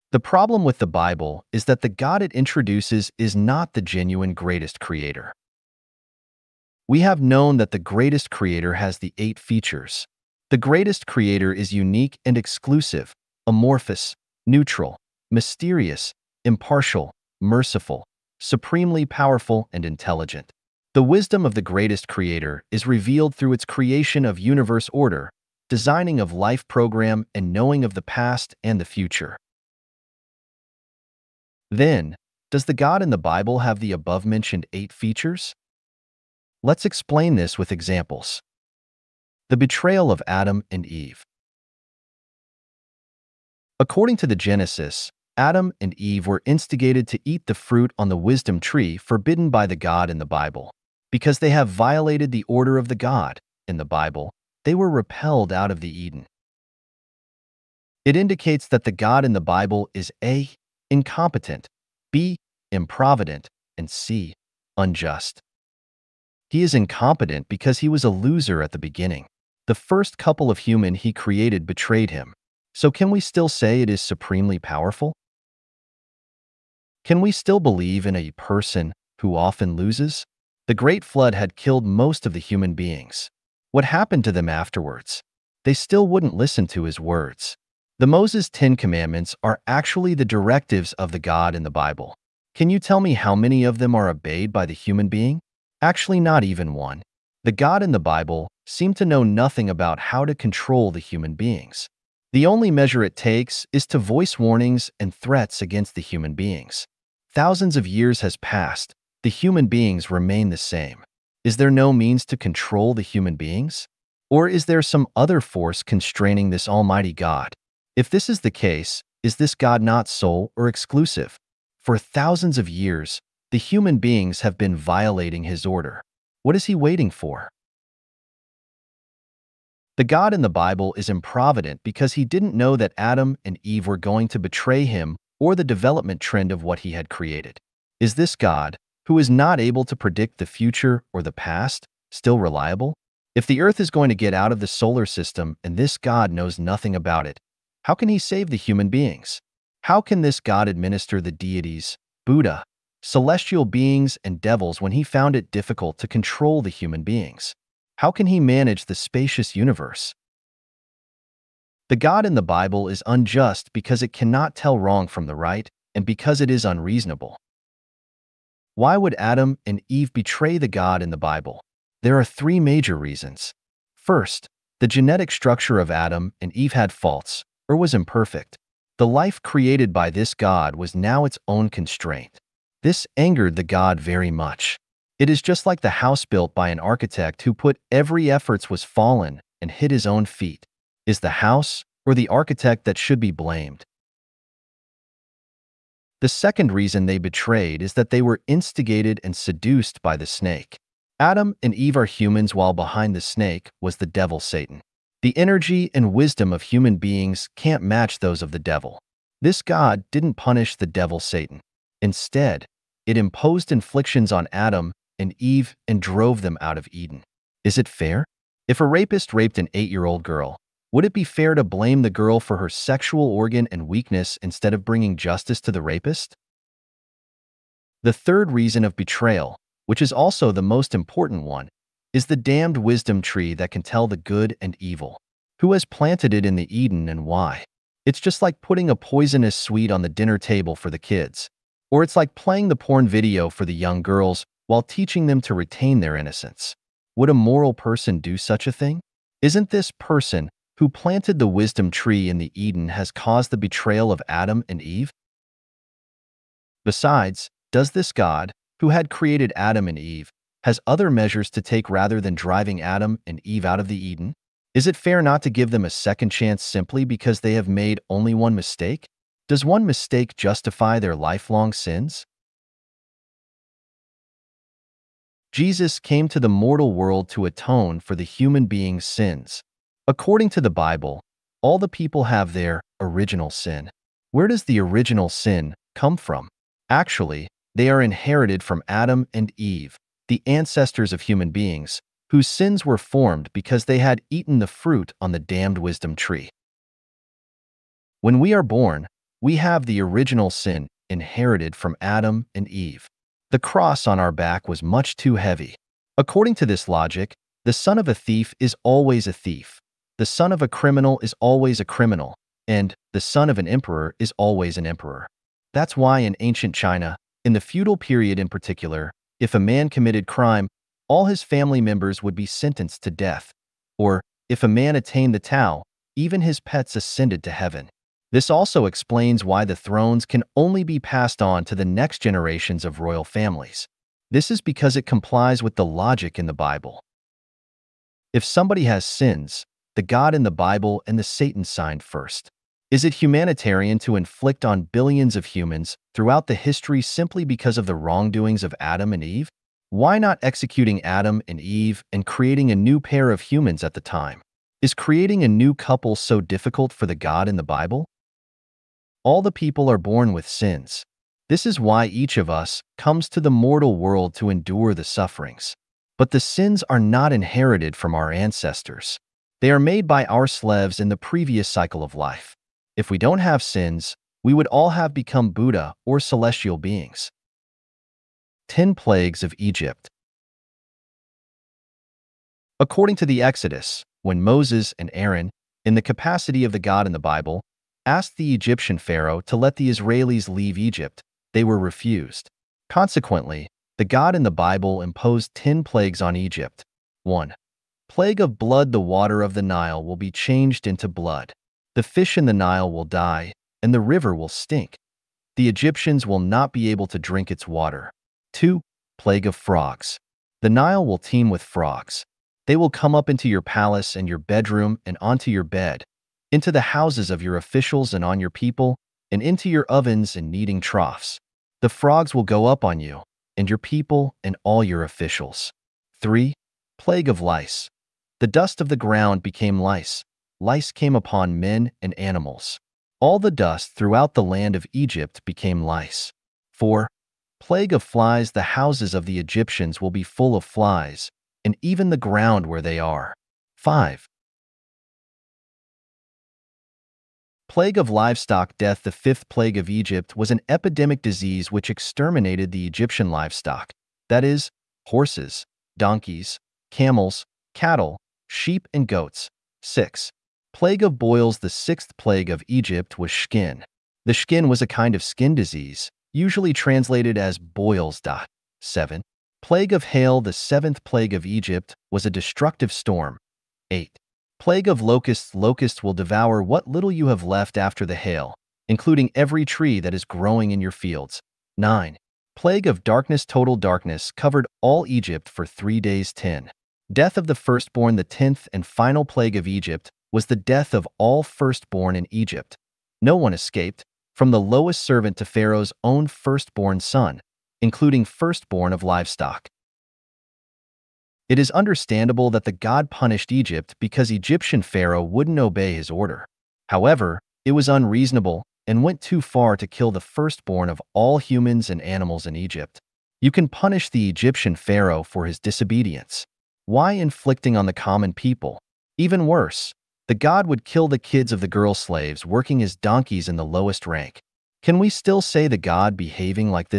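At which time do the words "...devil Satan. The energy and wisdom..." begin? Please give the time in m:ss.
3:24.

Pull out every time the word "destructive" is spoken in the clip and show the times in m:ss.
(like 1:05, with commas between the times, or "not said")
7:52.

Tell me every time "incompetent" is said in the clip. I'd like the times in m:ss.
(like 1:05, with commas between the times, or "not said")
1:00, 1:06.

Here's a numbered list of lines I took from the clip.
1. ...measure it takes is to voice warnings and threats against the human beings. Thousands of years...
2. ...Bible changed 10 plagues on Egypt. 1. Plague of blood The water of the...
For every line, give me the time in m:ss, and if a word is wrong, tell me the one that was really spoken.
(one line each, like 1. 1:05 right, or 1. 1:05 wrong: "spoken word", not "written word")
1. 1:42 right
2. 6:34 wrong: "imposed", not "changed".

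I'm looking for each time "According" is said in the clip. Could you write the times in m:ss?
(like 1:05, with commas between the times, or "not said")
0:43, 4:40, 5:06, 6:22.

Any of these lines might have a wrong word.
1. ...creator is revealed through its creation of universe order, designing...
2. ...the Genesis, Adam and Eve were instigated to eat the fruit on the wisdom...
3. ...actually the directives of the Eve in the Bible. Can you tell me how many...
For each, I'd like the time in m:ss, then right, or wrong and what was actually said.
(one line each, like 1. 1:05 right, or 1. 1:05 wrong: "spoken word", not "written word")
1. 0:22 right
2. 0:44 right
3. 1:29 wrong: "God", not "Eve".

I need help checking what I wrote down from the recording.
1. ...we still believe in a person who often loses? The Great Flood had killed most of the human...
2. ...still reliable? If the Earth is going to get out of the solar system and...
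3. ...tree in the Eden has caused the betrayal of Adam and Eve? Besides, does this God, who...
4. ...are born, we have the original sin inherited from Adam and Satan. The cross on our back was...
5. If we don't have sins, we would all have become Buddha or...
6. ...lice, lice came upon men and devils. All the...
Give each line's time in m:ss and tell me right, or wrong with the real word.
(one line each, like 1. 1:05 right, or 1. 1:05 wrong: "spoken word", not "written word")
1. 1:17 right
2. 2:22 right
3. 4:11 right
4. 4:58 wrong: "Eve", not "Satan"
5. 6:12 right
6. 7:09 wrong: "animals", not "devils".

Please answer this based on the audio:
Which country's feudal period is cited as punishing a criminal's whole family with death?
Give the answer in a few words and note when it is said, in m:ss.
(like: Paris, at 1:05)
China, at 5:16.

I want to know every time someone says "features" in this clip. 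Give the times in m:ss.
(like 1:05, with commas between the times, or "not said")
0:09, 0:34.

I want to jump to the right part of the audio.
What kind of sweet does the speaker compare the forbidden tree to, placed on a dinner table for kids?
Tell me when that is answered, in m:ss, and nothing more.
3:58.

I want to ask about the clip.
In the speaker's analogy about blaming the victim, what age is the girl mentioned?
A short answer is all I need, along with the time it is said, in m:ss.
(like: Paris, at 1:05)
8, at 3:39.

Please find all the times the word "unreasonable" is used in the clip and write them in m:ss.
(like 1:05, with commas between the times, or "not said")
2:46, 8:27.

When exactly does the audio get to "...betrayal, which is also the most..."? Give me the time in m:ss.
3:48.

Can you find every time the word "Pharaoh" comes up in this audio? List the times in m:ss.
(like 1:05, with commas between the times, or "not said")
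6:28, 8:15, 8:24, 8:34.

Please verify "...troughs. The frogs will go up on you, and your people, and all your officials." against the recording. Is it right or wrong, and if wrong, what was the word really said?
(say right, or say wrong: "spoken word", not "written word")
right.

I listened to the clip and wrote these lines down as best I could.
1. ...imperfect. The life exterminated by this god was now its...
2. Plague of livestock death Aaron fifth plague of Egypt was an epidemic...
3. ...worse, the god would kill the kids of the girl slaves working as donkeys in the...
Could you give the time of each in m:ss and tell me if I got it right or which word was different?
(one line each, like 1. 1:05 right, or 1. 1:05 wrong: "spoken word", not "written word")
1. 2:57 wrong: "created", not "exterminated"
2. 7:27 wrong: "The", not "Aaron"
3. 8:39 right.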